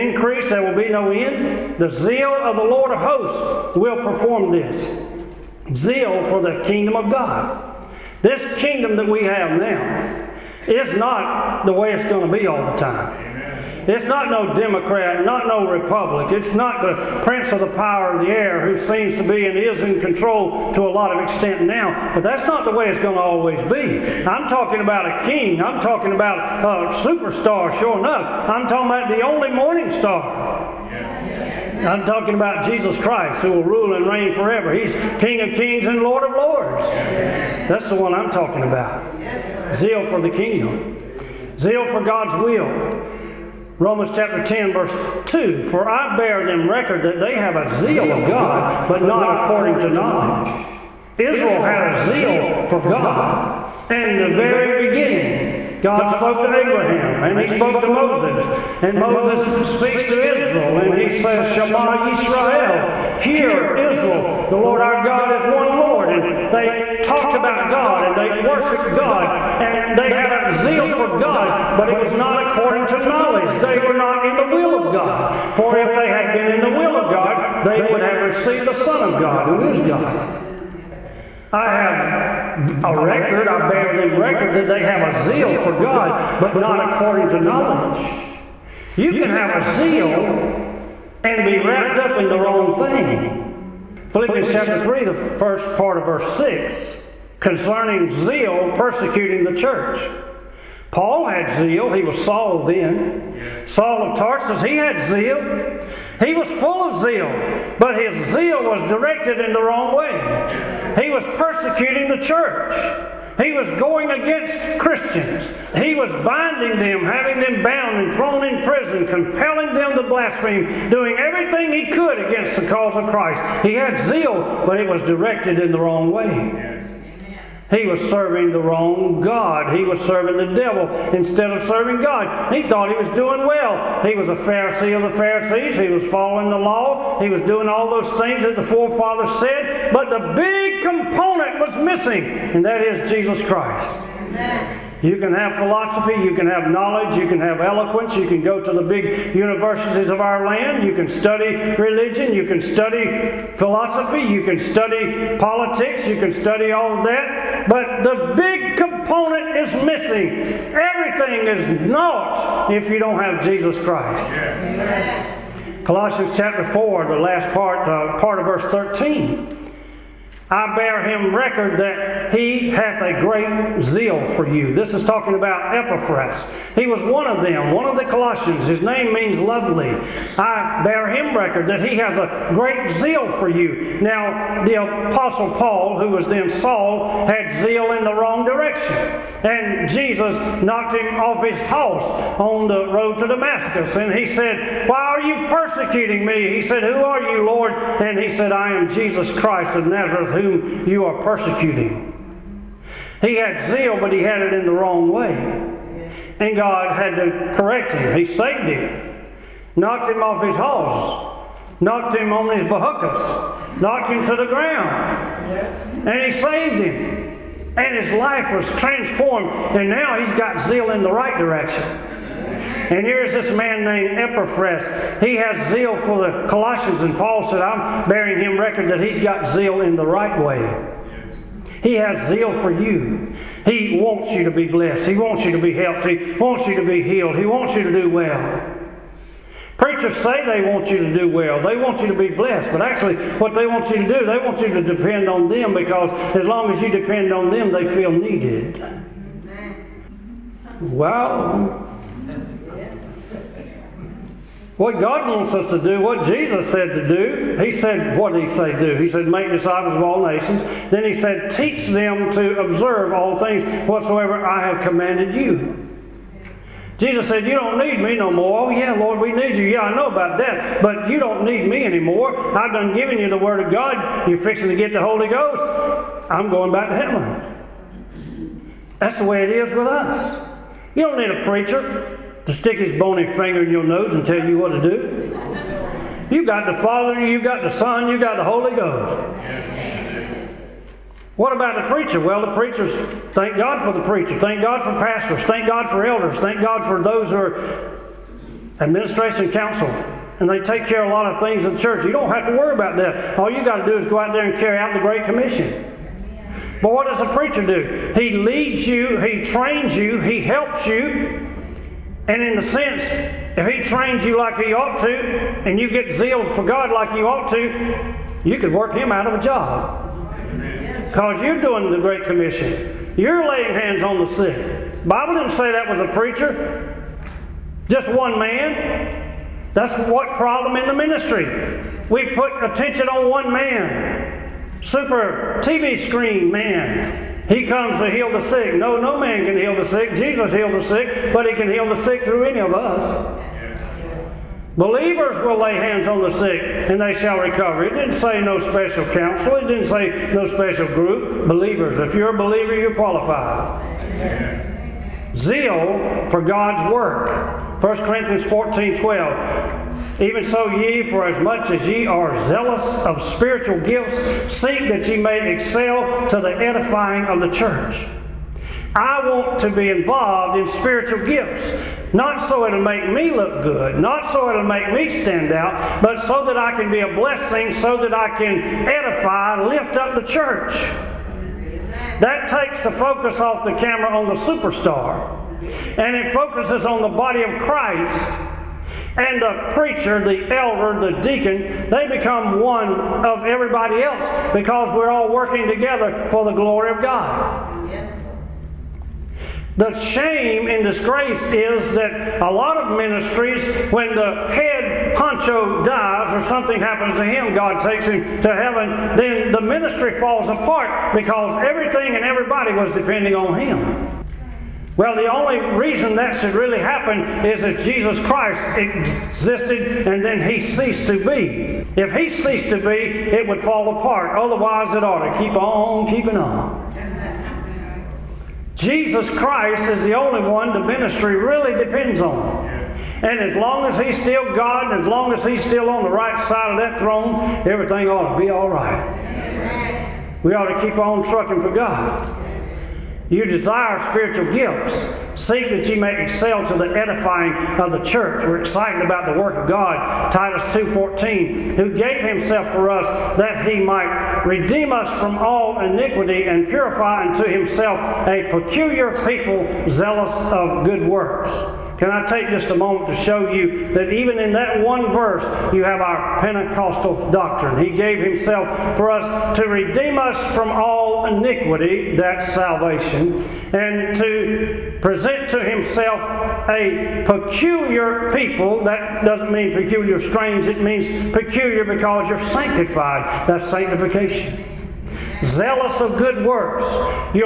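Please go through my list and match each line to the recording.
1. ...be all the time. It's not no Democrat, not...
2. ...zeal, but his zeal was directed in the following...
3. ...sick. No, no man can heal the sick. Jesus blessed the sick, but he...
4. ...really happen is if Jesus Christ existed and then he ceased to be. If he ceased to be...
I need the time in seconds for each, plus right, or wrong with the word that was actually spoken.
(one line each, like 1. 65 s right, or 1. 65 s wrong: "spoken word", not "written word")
1. 12 s right
2. 107 s wrong: "wrong", not "following"
3. 338 s wrong: "healed", not "blessed"
4. 416 s right.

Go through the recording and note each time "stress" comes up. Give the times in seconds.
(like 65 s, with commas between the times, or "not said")
not said.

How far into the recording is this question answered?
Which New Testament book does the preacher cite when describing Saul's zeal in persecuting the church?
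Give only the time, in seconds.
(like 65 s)
94 s.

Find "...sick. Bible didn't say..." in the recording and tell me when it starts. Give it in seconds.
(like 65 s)
324 s.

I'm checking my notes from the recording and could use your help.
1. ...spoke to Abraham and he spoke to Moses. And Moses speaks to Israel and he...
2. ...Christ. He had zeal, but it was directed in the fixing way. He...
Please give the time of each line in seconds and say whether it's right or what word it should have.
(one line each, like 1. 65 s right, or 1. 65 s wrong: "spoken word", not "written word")
1. 56 s right
2. 123 s wrong: "wrong", not "fixing".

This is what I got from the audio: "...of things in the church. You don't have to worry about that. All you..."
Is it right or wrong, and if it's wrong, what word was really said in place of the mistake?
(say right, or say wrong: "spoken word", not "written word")
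right.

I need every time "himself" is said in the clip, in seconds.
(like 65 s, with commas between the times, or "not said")
452 s, 457 s, 468 s, 475 s.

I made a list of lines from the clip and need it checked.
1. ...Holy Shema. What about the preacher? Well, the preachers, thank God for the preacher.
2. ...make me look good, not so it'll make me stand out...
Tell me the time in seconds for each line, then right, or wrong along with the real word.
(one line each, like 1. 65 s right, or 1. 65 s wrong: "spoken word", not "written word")
1. 288 s wrong: "Ghost", not "Shema"
2. 372 s right.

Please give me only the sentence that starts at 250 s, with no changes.
Well, what God wants us to do, what Jesus said to do, He said, What did He say do?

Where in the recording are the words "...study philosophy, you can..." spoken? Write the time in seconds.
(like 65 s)
152 s.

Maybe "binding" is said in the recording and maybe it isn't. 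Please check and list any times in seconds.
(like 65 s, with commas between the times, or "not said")
116 s.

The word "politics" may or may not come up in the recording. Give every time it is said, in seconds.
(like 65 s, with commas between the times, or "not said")
155 s.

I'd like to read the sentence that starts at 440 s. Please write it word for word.
We ought to keep on trucking for God.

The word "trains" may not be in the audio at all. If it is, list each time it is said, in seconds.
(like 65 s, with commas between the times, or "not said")
309 s, 313 s.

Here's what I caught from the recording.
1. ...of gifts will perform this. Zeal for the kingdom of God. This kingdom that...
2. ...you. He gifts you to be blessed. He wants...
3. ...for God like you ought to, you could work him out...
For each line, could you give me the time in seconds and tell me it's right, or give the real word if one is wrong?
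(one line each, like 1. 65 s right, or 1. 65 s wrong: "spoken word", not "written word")
1. 2 s wrong: "hosts", not "gifts"
2. 232 s wrong: "wants", not "gifts"
3. 316 s right.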